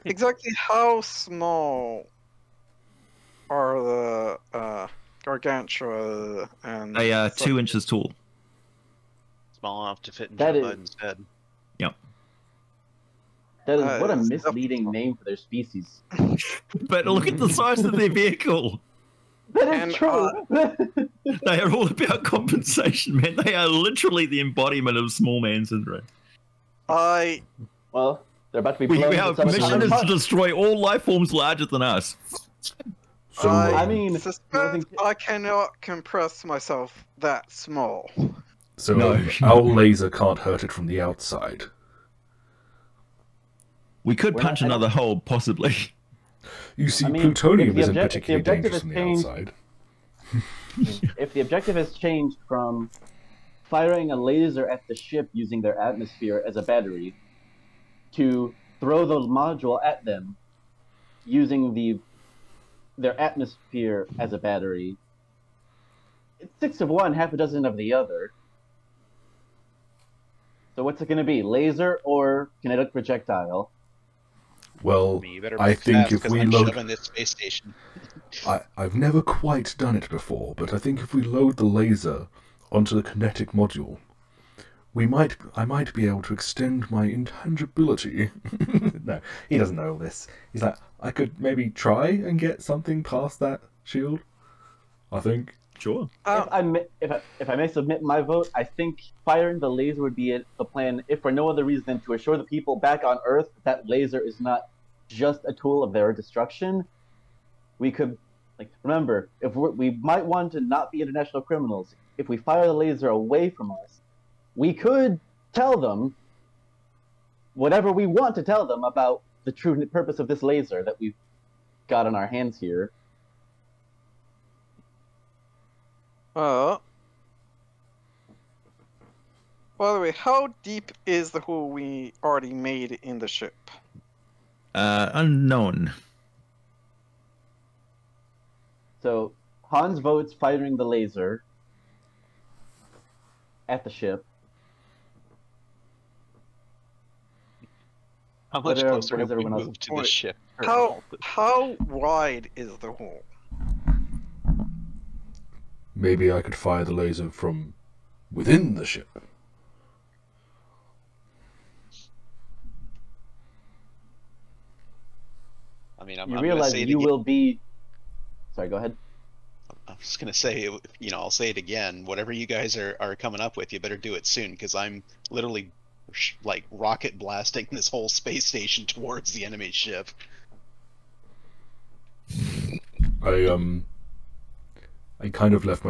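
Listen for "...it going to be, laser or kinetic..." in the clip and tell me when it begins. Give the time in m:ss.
1:10.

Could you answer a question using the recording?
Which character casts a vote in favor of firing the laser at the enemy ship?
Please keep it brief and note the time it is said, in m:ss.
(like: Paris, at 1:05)
Hans, at 2:19.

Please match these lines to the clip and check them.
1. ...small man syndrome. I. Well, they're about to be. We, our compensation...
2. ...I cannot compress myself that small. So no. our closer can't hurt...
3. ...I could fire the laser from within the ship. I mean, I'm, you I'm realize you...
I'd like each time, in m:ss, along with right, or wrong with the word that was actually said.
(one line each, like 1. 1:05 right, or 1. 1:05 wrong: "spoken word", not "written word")
1. 0:25 wrong: "mission", not "compensation"
2. 0:35 wrong: "laser", not "closer"
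3. 2:36 right.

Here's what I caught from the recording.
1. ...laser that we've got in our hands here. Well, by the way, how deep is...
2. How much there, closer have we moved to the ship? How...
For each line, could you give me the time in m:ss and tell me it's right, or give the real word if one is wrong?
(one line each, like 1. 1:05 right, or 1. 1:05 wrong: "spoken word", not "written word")
1. 2:00 right
2. 2:28 right.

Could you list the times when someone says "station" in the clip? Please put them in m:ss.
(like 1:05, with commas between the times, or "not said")
1:17, 2:58.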